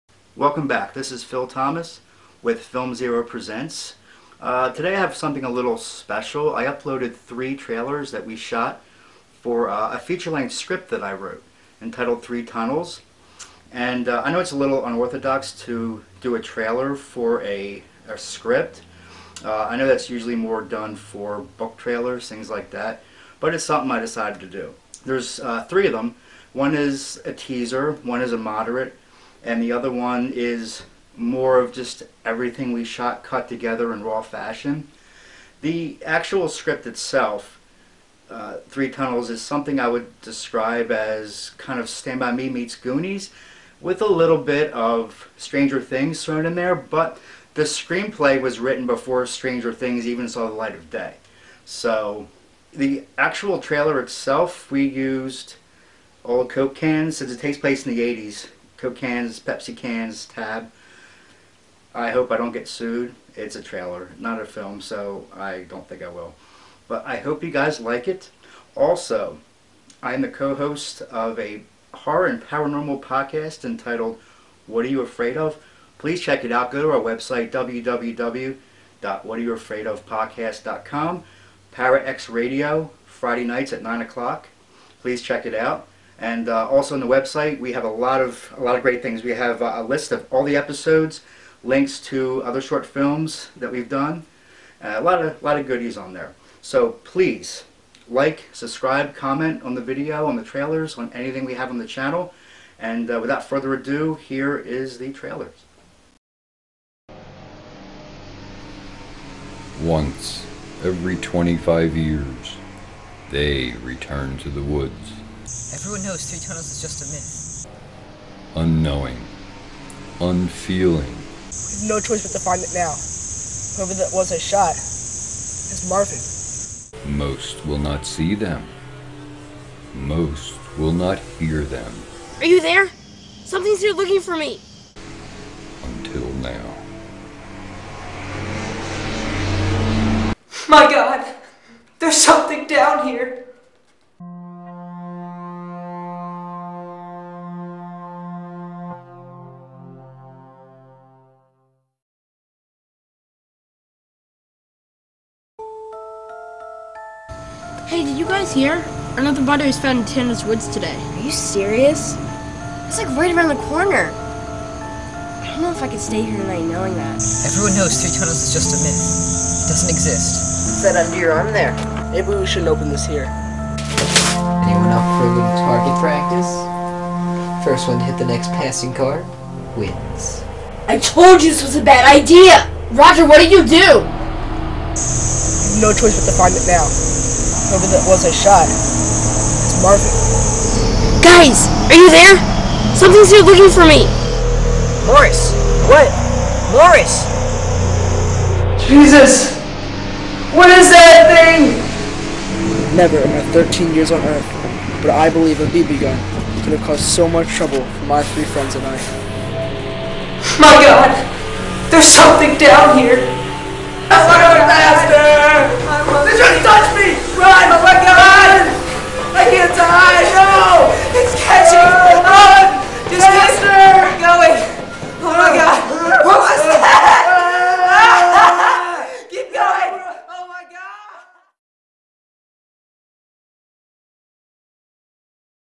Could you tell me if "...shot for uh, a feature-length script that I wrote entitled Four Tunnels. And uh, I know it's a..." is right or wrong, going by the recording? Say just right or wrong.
wrong.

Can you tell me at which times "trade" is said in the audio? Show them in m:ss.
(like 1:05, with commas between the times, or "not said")
not said.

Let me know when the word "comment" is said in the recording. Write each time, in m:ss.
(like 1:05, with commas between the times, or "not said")
1:39.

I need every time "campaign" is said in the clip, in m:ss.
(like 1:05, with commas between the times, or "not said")
not said.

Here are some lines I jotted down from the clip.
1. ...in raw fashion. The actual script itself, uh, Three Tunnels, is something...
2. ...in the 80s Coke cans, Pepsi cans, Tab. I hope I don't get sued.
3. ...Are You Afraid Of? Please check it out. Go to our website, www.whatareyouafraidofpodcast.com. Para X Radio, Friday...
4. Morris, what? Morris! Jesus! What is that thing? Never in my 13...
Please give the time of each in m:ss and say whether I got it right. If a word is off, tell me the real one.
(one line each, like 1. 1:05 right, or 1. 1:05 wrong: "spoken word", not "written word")
1. 0:33 right
2. 0:57 right
3. 1:14 right
4. 3:15 right.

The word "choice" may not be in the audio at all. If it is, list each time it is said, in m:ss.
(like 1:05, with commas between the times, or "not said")
2:01, 3:05.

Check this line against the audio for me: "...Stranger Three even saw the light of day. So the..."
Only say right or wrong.
wrong.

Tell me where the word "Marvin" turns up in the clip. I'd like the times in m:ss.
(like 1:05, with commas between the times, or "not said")
2:05, 3:09.